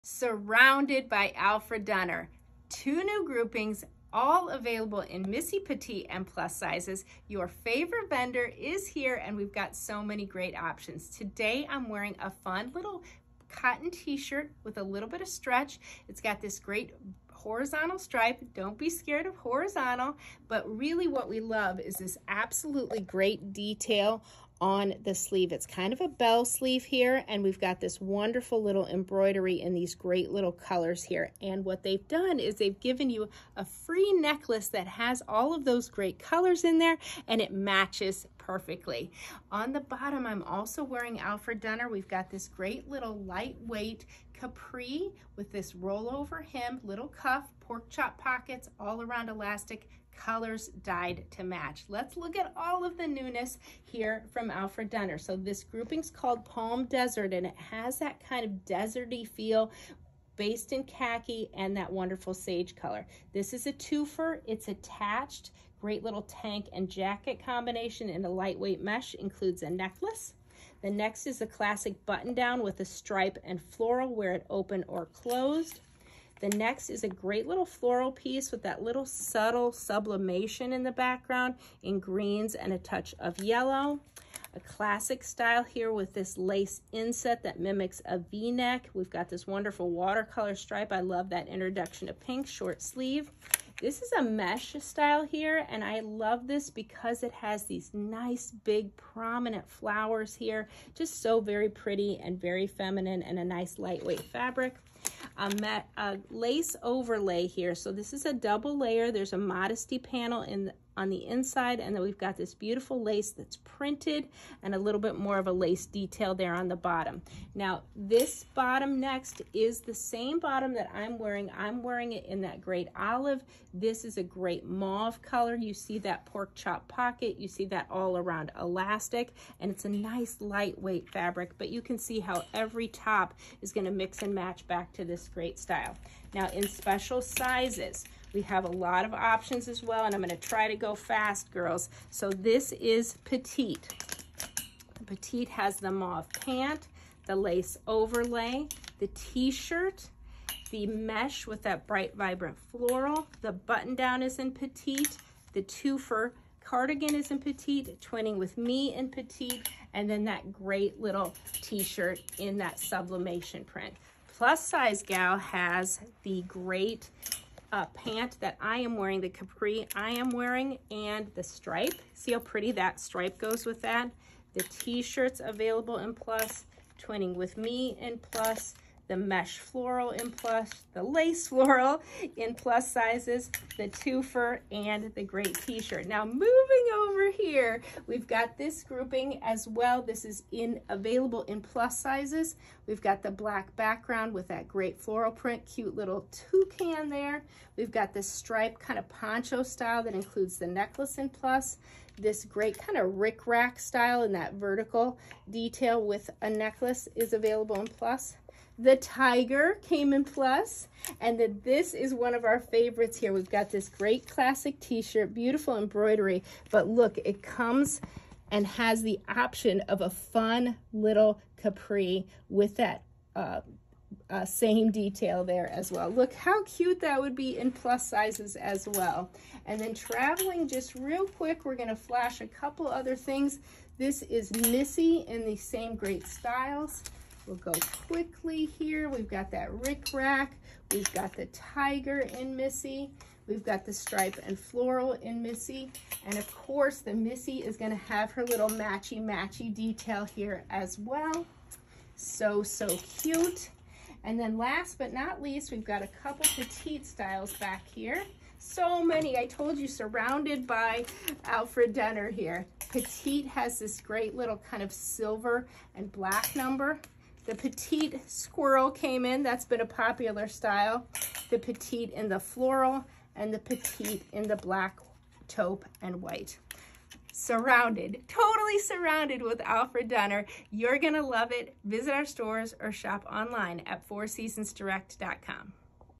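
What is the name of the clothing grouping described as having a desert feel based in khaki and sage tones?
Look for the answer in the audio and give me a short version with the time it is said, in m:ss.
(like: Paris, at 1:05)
Palm Desert, at 0:56.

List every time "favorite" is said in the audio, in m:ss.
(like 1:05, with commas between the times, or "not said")
0:07, 3:32.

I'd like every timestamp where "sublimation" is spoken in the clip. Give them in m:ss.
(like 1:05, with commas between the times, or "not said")
1:19, 2:42.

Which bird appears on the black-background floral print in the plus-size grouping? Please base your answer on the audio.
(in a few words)
toucan.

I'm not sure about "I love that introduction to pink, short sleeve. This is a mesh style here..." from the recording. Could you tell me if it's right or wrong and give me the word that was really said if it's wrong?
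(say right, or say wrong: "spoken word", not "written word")
right.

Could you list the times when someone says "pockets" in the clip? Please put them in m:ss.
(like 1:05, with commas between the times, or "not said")
0:48, 2:06.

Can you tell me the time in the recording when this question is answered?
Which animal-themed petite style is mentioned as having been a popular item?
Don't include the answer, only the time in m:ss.
4:28.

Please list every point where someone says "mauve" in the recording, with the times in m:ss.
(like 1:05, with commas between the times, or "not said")
2:04, 2:25.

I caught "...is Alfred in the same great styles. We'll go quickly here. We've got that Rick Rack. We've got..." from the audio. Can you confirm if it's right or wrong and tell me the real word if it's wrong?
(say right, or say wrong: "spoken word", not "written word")
wrong: "Missy", not "Alfred".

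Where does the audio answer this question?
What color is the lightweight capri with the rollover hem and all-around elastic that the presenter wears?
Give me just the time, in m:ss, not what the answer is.
2:02.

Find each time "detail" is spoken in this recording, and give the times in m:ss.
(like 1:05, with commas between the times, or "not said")
0:23, 1:55, 3:25, 3:44, 4:09.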